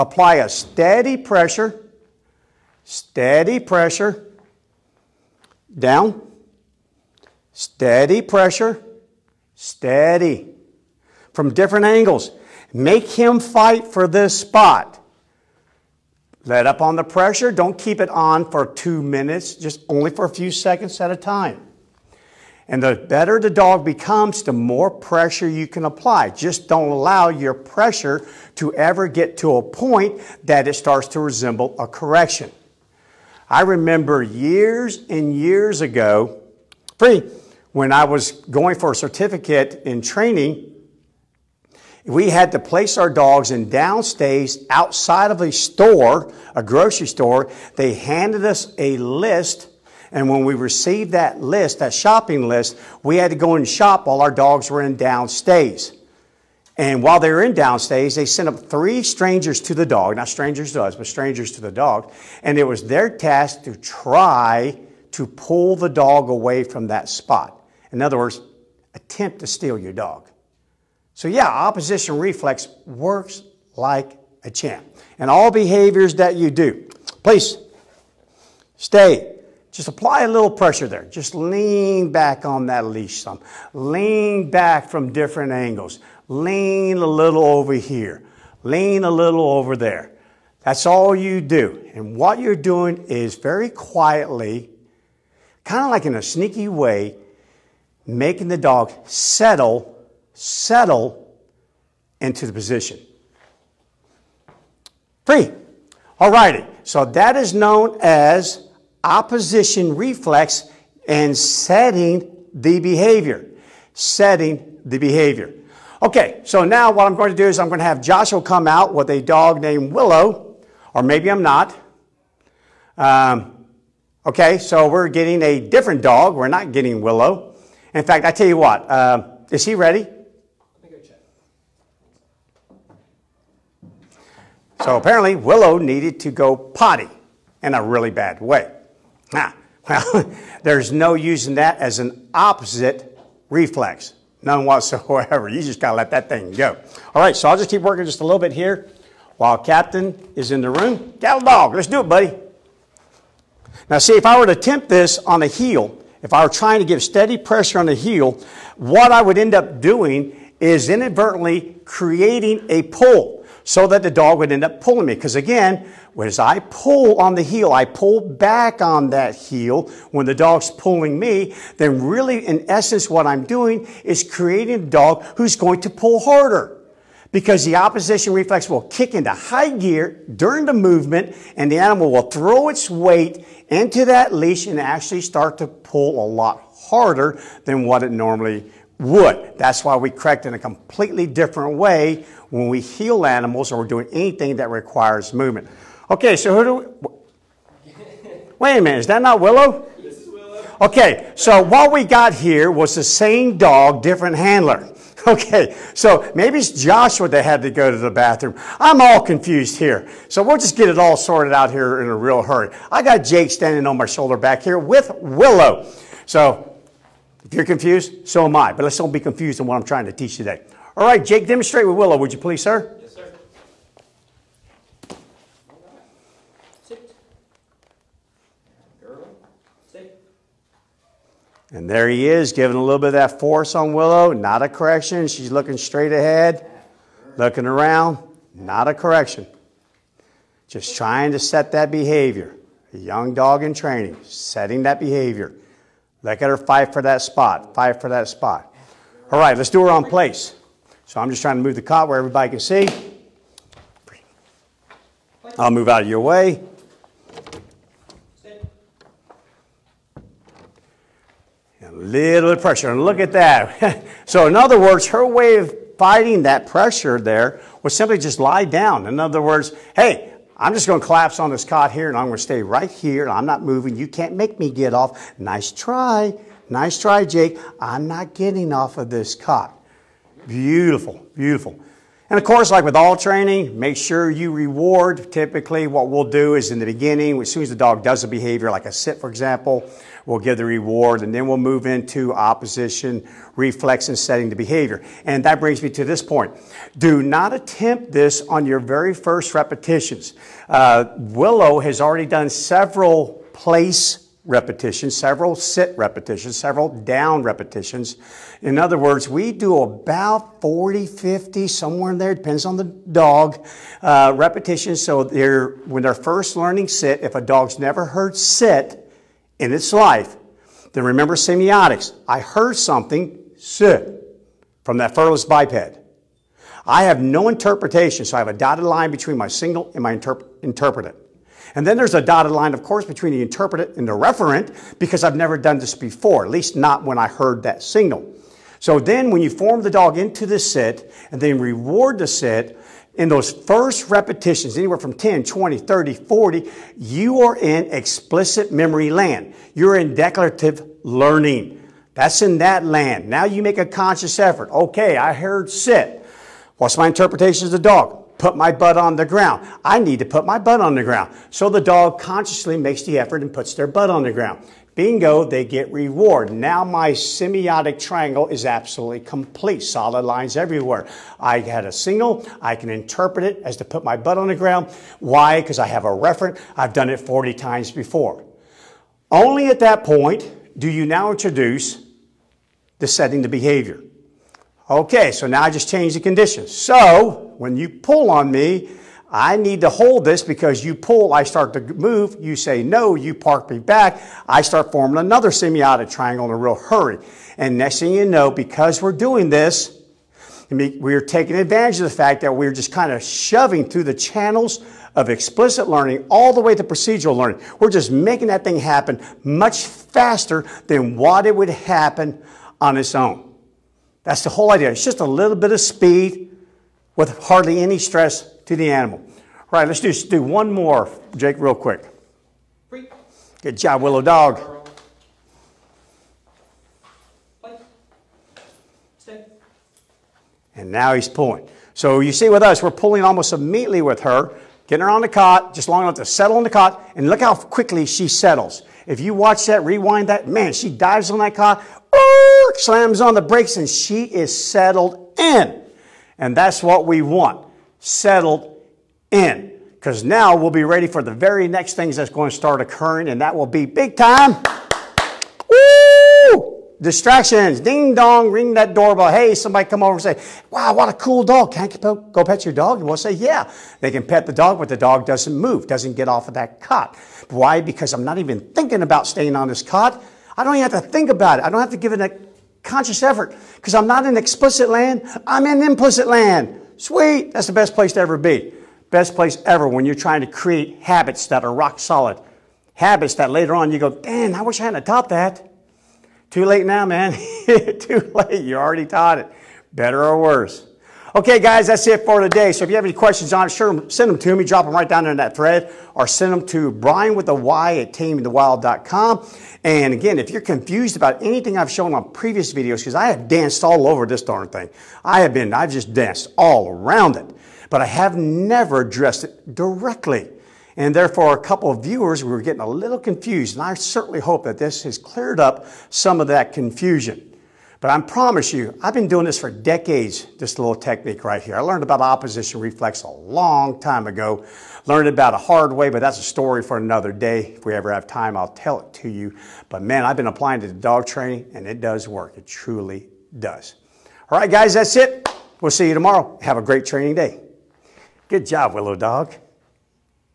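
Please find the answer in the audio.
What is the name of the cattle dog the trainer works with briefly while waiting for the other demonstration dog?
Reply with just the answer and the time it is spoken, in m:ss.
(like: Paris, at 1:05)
Captain, at 2:29.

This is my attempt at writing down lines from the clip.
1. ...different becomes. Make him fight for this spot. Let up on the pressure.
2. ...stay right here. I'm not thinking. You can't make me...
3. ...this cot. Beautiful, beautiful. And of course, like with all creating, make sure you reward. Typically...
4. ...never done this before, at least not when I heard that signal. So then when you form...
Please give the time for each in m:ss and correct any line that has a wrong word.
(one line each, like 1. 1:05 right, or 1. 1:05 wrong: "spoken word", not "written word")
1. 0:11 wrong: "angles", not "becomes"
2. 4:32 wrong: "moving", not "thinking"
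3. 4:39 wrong: "training", not "creating"
4. 5:35 right.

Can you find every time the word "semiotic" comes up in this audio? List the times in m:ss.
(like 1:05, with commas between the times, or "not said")
5:21, 6:07, 6:35.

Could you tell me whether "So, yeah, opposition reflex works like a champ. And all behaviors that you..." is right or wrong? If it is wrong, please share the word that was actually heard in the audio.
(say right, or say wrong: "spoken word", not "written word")
right.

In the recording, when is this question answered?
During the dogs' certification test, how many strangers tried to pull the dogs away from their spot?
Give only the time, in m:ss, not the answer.
0:58.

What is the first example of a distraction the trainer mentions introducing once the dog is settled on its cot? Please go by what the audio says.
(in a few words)
doorbell.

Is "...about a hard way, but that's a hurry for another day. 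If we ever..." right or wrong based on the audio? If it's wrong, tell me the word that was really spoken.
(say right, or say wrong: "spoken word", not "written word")
wrong: "story", not "hurry".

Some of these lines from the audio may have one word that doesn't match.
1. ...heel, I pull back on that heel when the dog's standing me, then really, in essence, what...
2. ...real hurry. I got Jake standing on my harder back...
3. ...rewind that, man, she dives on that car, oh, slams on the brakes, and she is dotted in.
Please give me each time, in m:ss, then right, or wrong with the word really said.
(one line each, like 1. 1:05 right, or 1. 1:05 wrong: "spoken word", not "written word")
1. 2:47 wrong: "pulling", not "standing"
2. 3:32 wrong: "shoulder", not "harder"
3. 7:19 wrong: "settled", not "dotted".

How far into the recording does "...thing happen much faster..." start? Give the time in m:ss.
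6:48.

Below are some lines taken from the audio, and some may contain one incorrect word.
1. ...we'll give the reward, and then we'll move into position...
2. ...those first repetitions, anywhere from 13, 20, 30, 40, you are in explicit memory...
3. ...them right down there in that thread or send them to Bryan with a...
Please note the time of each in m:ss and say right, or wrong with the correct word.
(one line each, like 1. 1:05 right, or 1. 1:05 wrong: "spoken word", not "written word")
1. 4:50 wrong: "opposition", not "position"
2. 5:43 wrong: "10", not "13"
3. 8:14 right.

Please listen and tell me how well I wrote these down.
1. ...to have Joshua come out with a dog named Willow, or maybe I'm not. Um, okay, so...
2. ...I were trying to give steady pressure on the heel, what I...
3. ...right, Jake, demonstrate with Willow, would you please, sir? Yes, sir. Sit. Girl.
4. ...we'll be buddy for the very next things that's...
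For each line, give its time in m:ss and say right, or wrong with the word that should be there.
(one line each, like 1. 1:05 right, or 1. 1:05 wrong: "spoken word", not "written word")
1. 1:57 right
2. 2:36 right
3. 3:41 right
4. 7:30 wrong: "ready", not "buddy".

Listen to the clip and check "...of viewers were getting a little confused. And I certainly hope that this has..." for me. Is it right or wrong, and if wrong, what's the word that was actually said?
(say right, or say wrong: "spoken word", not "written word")
right.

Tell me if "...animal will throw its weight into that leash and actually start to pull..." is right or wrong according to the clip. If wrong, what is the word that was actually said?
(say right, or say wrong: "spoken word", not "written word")
right.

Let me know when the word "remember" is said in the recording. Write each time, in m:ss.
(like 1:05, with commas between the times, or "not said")
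0:33, 5:21.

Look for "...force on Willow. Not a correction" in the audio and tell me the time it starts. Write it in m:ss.
3:53.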